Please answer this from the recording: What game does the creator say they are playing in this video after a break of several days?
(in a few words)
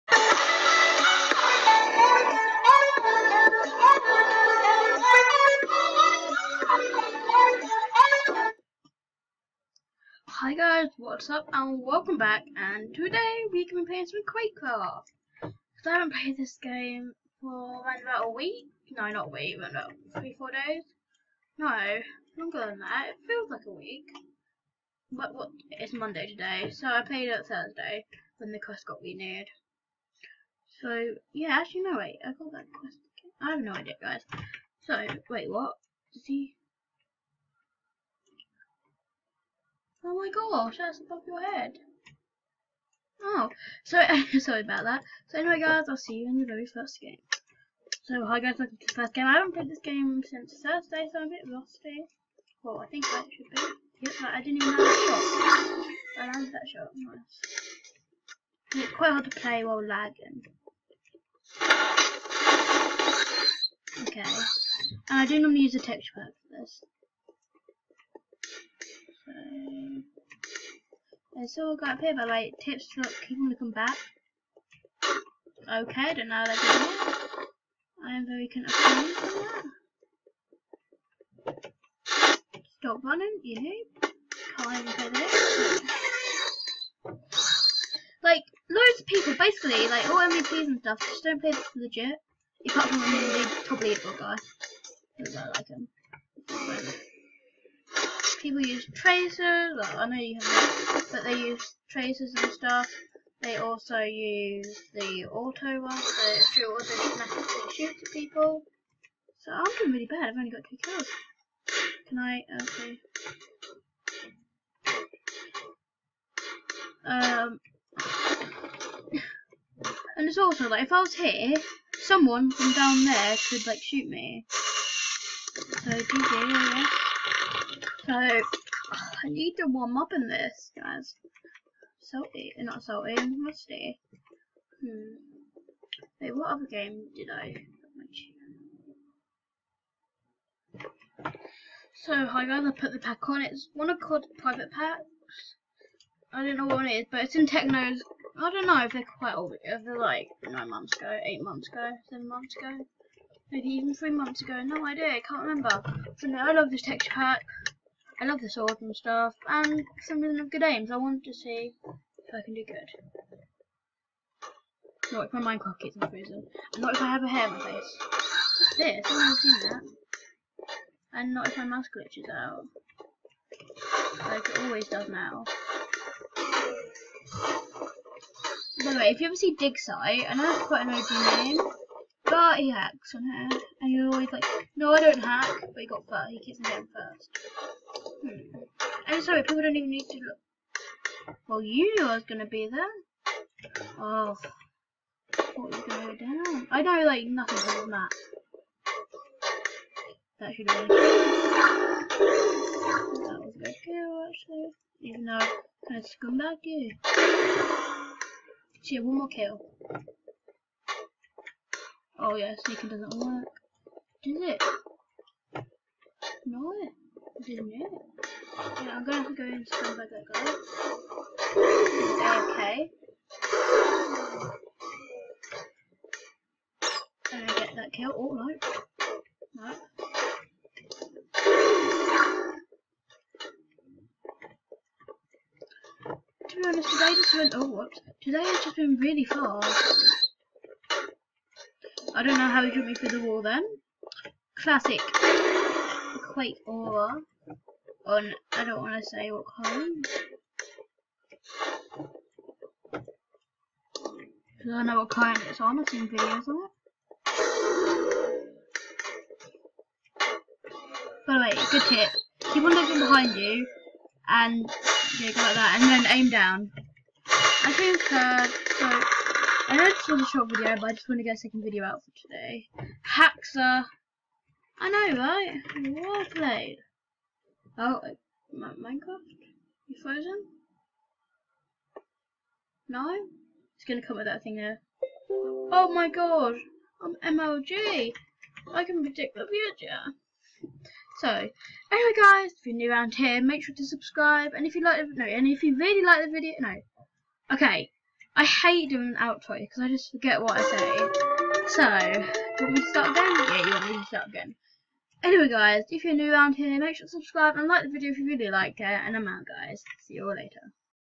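Quakecraft.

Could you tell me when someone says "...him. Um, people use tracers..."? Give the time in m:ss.
1:35.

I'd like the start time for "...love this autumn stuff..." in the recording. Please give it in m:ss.
2:38.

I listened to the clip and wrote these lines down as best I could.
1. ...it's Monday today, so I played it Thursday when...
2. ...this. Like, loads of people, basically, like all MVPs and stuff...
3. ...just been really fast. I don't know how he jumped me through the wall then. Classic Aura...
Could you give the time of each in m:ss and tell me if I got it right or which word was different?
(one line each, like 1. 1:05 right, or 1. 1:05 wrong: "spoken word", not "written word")
1. 0:25 right
2. 1:25 right
3. 3:58 wrong: "Quake", not "Aura".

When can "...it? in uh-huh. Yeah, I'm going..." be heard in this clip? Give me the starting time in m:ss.
3:34.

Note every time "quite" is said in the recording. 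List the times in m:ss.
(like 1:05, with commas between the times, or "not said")
0:58, 2:29, 3:00.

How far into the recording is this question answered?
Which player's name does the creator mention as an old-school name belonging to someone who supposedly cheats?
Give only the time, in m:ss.
2:59.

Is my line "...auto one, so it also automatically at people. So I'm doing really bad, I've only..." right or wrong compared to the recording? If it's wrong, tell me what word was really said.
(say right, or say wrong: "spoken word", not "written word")
right.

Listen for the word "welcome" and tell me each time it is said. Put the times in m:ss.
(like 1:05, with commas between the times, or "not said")
0:11, 0:48.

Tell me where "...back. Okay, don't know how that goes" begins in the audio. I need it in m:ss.
1:13.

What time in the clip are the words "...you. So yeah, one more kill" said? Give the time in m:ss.
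3:26.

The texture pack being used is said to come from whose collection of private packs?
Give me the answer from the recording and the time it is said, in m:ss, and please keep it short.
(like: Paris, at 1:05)
Techno, at 2:27.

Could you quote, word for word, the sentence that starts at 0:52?
Well, I think that should be.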